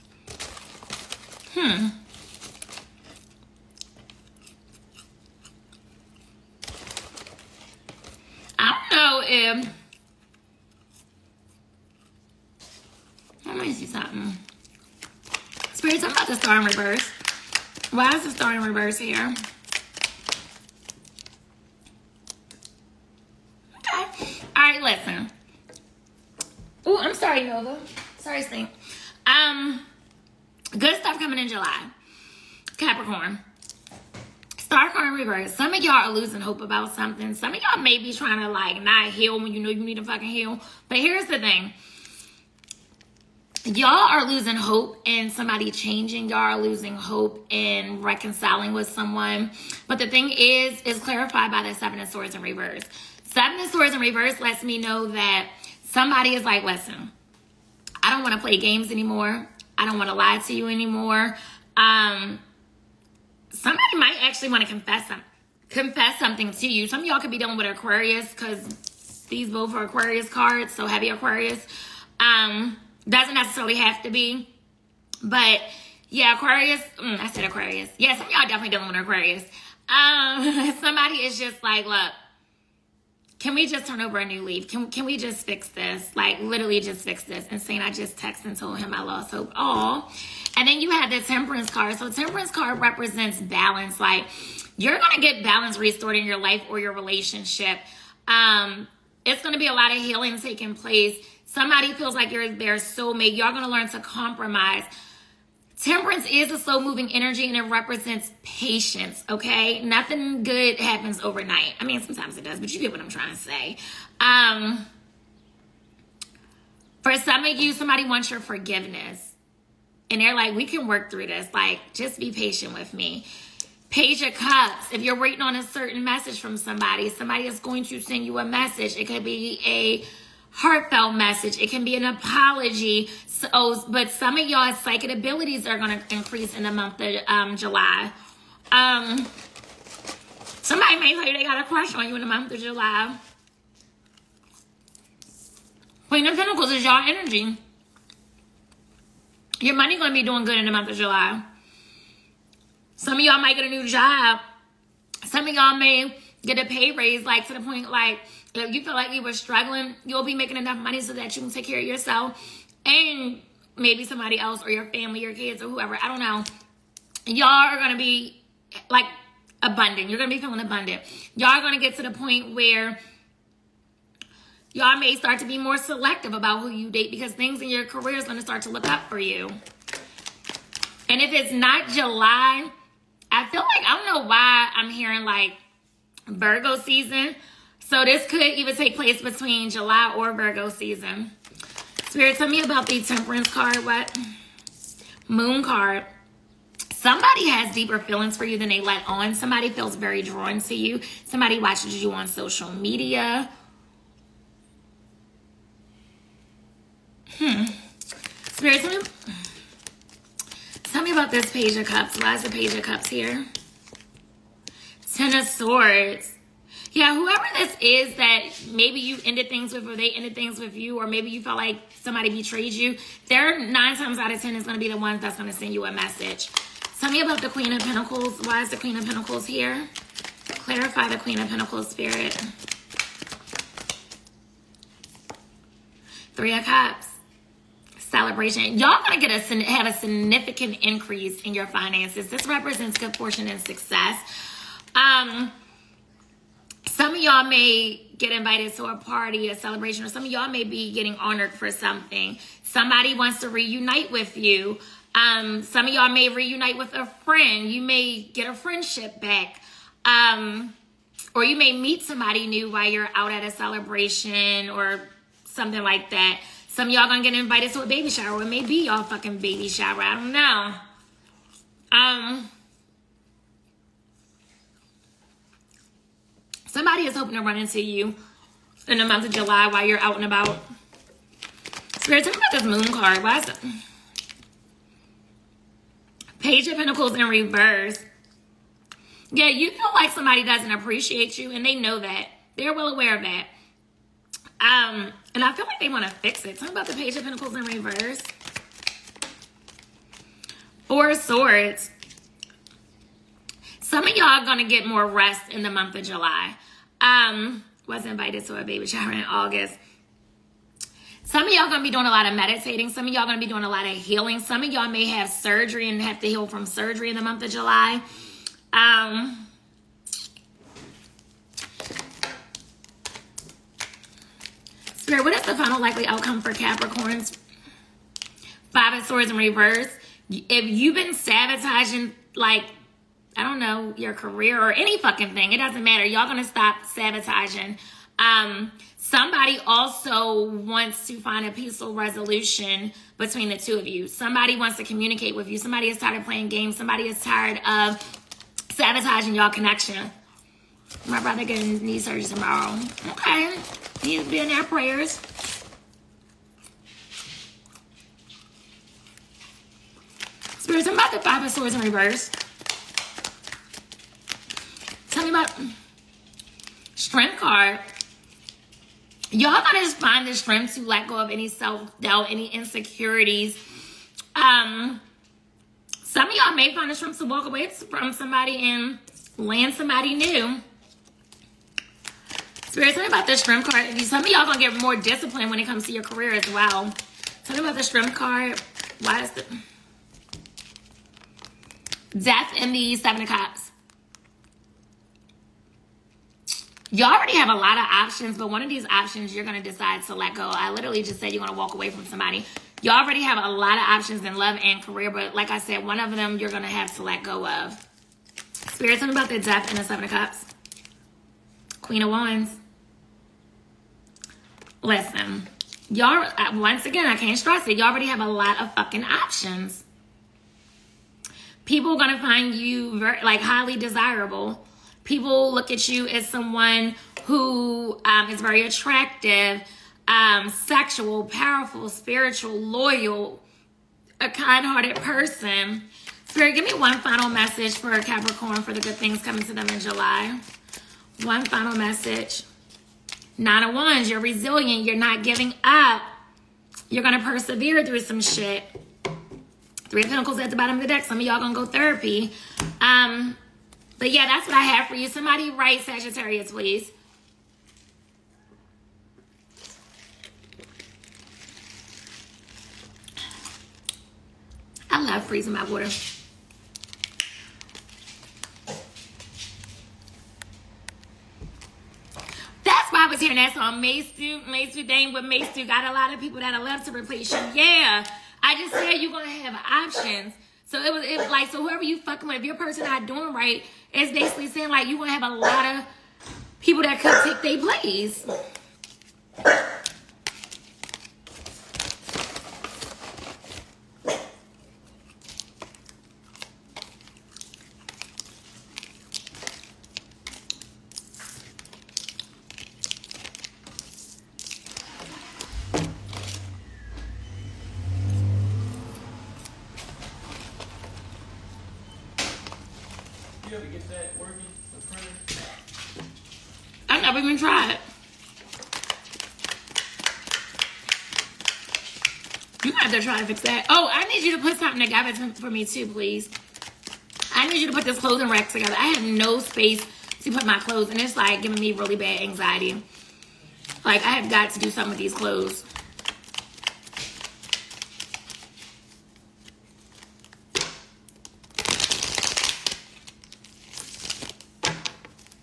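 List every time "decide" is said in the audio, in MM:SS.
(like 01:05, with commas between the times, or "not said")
06:39.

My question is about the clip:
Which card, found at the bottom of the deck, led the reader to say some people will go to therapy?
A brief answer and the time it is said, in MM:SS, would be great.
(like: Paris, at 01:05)
Three of Pentacles, at 07:29.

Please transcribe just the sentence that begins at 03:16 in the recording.
Somebody has deeper feelings for you than they let on.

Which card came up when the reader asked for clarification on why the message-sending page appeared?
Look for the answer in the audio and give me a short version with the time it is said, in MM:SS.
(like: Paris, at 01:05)
Ten of Swords, at 03:35.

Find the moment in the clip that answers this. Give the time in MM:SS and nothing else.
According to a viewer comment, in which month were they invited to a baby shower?
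05:08.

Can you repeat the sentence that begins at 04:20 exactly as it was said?
Um, or you may meet somebody new while you're out at a celebration or something like that.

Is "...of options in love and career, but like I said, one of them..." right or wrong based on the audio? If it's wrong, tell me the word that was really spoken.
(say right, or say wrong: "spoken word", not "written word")
right.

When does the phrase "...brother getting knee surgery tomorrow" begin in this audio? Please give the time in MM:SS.
05:51.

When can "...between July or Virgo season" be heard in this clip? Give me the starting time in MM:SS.
03:09.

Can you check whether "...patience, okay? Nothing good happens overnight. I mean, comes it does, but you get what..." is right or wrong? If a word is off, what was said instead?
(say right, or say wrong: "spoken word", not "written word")
wrong: "sometimes", not "comes".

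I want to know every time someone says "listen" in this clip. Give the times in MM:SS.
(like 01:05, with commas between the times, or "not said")
00:24, 00:56, 06:54.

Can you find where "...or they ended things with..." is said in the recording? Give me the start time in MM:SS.
03:39.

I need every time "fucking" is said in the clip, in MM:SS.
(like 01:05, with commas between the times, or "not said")
00:40, 04:29, 05:34, 06:58, 08:01.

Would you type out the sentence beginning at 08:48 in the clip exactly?
I have no space to put my clothes, and it's like giving me really bad anxiety.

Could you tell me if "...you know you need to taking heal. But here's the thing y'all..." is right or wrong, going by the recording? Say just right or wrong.
wrong.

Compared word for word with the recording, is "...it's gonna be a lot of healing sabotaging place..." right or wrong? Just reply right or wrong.
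wrong.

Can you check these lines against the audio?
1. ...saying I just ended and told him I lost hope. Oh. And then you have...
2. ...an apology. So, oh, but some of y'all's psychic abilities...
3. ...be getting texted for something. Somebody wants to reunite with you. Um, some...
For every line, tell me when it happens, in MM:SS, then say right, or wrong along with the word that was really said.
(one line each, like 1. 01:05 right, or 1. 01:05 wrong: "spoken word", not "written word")
1. 01:27 wrong: "texted", not "ended"
2. 02:11 right
3. 04:10 wrong: "honored", not "texted".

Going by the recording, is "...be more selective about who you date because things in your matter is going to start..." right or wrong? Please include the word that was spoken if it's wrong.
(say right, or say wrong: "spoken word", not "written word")
wrong: "career", not "matter".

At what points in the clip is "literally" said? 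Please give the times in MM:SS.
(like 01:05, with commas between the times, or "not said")
01:26, 06:40.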